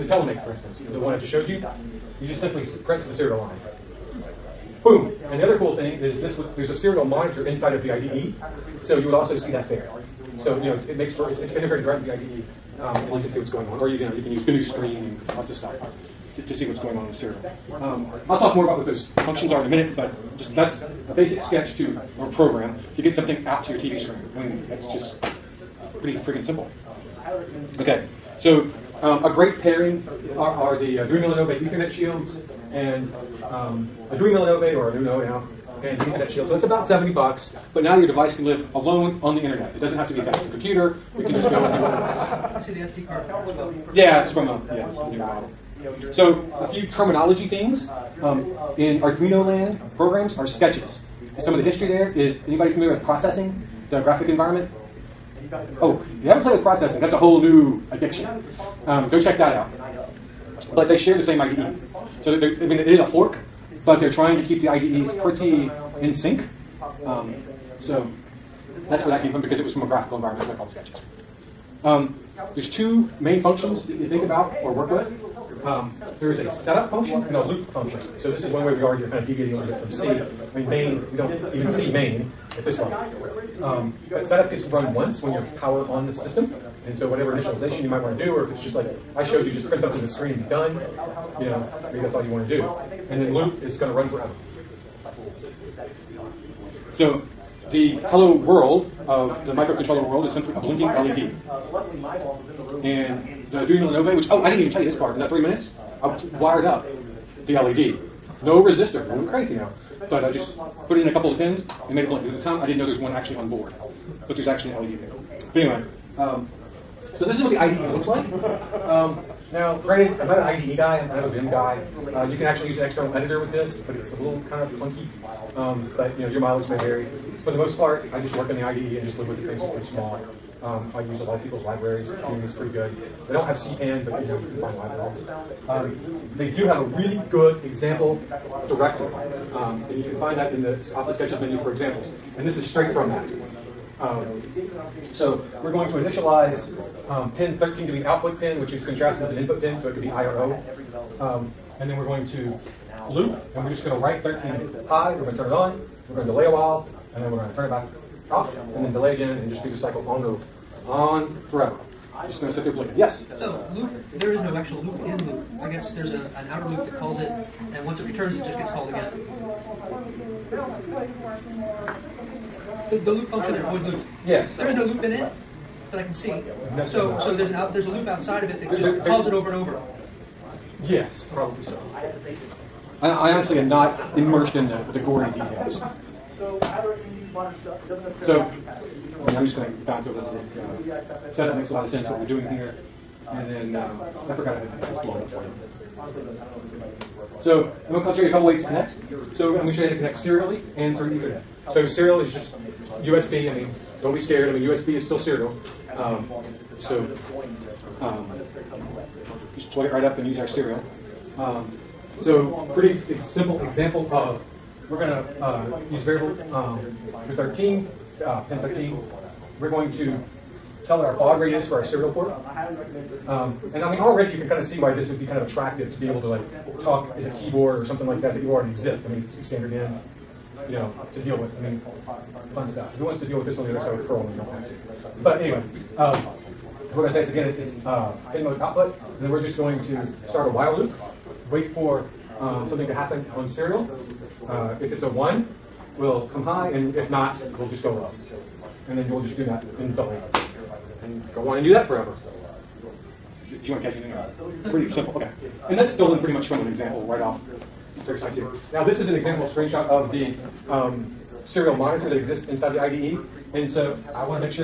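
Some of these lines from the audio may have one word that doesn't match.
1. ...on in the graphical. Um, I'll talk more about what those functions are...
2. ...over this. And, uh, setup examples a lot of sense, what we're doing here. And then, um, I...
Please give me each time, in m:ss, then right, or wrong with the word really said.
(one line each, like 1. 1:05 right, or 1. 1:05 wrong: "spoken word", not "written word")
1. 0:16 wrong: "serial", not "graphical"
2. 3:10 wrong: "makes", not "examples".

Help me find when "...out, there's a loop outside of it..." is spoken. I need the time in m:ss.
2:57.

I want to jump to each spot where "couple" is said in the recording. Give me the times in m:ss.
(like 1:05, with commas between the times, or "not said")
1:51, 3:18.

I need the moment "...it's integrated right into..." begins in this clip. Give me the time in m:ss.
0:11.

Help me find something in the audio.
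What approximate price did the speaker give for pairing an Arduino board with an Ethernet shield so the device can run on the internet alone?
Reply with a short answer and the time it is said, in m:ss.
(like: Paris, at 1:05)
$70, at 0:36.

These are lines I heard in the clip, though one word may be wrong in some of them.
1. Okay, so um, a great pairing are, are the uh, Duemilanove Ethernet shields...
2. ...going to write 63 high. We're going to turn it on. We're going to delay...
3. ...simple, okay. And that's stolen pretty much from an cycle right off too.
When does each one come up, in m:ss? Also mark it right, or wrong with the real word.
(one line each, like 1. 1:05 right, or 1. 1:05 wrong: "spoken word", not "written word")
1. 0:27 right
2. 2:33 wrong: "13", not "63"
3. 4:14 wrong: "example", not "cycle".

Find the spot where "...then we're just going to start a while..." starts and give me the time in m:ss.
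3:59.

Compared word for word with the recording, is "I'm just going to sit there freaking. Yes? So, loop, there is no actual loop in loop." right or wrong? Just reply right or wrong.
wrong.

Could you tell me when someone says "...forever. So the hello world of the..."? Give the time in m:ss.
1:34.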